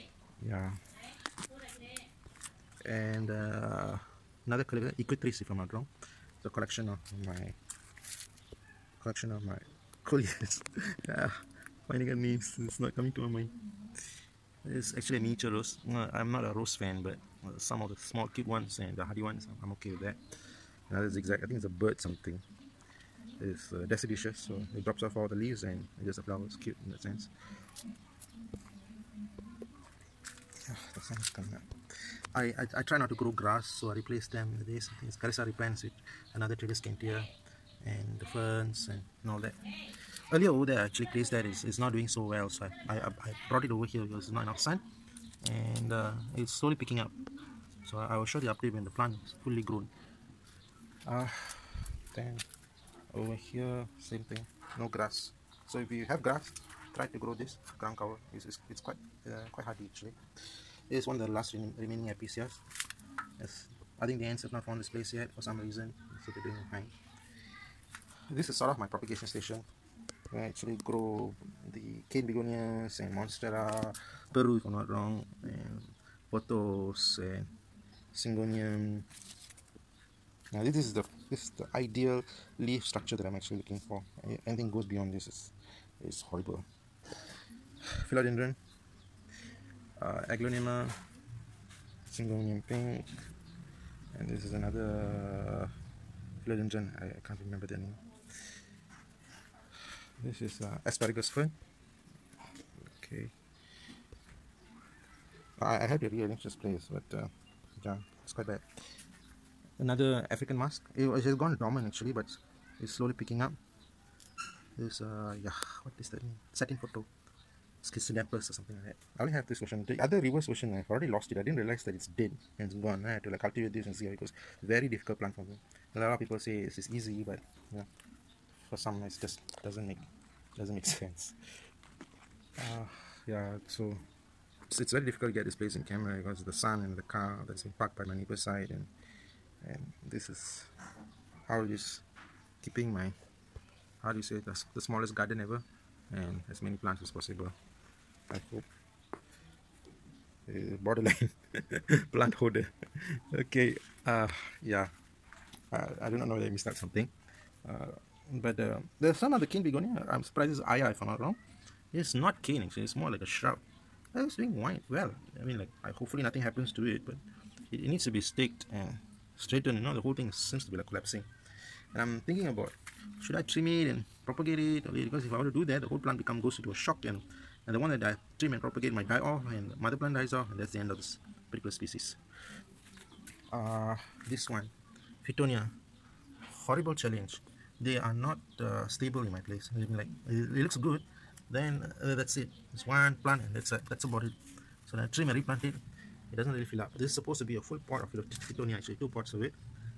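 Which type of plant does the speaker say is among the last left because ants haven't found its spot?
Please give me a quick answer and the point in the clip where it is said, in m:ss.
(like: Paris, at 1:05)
Episcias, at 1:02.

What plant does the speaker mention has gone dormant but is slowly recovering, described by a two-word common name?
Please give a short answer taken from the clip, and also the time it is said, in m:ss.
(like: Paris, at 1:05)
African mask, at 1:50.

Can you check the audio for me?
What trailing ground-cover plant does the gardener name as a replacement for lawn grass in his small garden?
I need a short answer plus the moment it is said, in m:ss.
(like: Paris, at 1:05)
Callisia repens, at 0:35.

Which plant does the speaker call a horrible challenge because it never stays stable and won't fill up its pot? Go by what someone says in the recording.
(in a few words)
Fittonia.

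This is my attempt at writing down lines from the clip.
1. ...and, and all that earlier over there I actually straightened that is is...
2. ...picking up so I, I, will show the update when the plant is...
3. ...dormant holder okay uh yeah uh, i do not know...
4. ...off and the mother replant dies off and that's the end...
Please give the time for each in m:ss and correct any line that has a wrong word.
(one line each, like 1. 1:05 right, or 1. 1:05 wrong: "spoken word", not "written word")
1. 0:38 wrong: "placed", not "straightened"
2. 0:46 right
3. 2:32 wrong: "plant", not "dormant"
4. 2:59 wrong: "plant", not "replant".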